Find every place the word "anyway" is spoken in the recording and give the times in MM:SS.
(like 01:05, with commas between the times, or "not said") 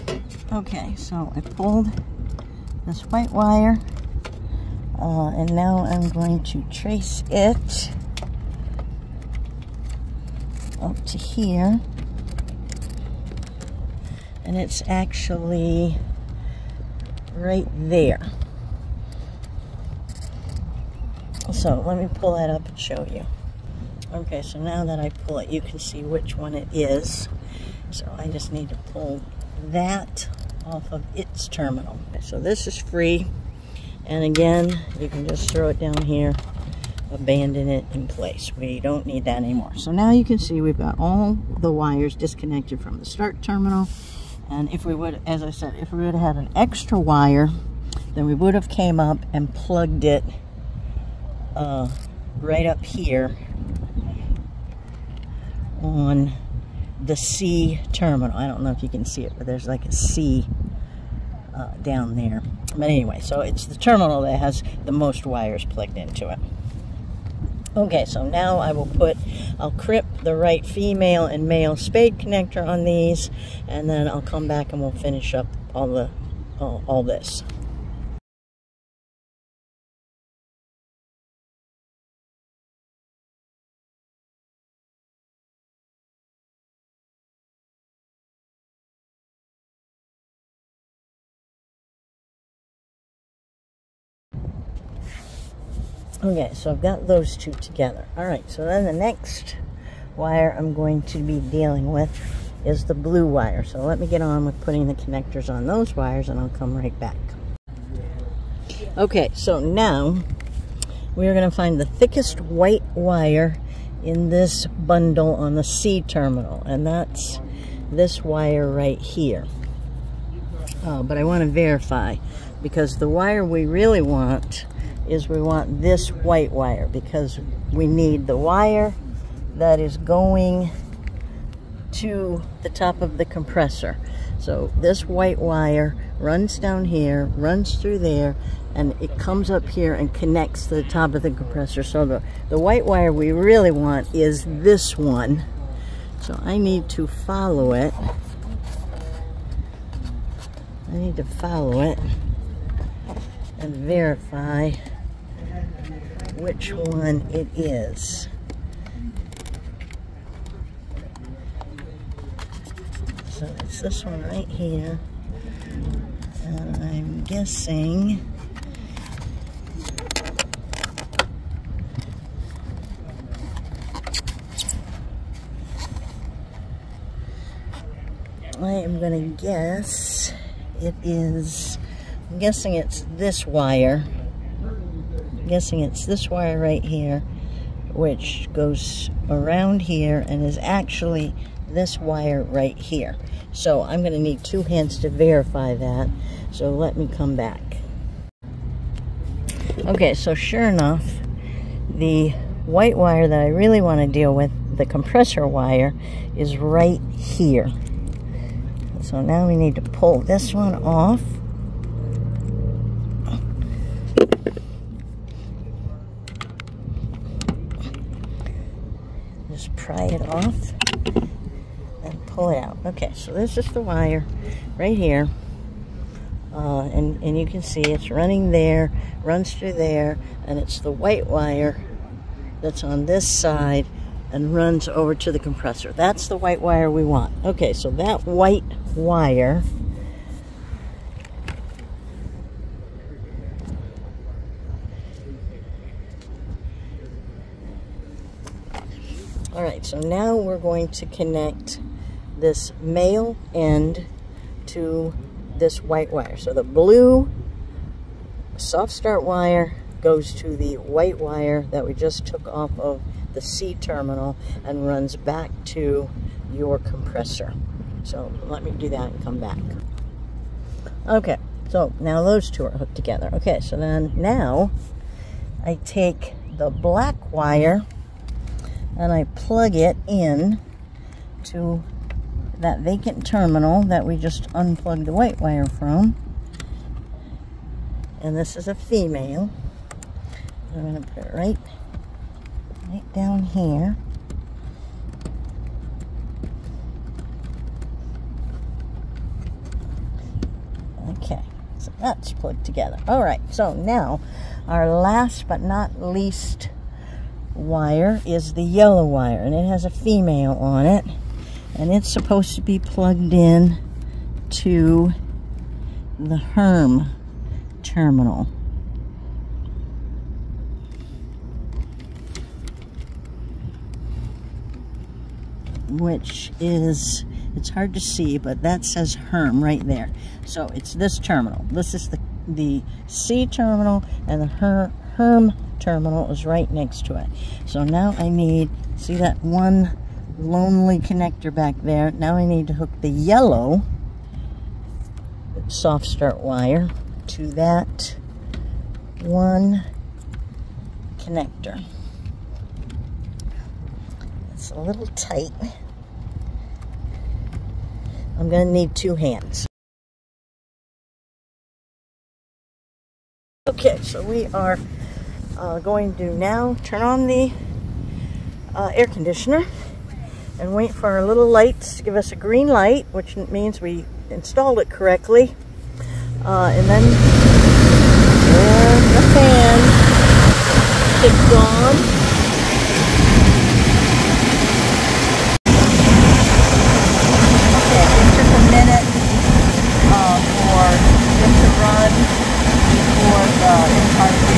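01:02.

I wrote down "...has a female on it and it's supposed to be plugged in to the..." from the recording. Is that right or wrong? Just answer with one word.
right.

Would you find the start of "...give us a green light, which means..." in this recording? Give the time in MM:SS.
06:12.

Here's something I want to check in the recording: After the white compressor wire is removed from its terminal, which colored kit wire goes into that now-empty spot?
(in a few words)
black.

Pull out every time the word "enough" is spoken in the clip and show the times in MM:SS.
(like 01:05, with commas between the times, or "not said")
03:20.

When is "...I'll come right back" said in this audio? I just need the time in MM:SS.
01:46.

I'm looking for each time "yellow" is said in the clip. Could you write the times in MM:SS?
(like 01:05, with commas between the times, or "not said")
05:08, 05:43.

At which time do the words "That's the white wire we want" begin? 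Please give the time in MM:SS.
03:55.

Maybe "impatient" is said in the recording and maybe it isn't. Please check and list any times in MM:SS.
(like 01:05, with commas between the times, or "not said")
not said.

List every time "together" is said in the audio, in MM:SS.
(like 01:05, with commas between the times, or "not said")
01:37, 04:32, 05:02.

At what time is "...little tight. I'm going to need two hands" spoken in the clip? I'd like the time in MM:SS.
05:54.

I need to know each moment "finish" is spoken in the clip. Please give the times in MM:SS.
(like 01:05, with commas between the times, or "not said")
01:14.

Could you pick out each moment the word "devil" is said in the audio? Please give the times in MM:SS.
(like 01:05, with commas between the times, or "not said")
not said.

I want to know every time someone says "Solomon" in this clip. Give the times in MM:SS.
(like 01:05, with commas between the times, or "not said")
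not said.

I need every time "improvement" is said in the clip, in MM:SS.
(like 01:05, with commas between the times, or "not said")
not said.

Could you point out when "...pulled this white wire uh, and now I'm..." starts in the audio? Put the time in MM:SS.
00:01.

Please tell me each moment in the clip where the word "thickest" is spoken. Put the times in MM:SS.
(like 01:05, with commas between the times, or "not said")
01:51.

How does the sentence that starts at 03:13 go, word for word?
So I'm going to need two hands to verify that.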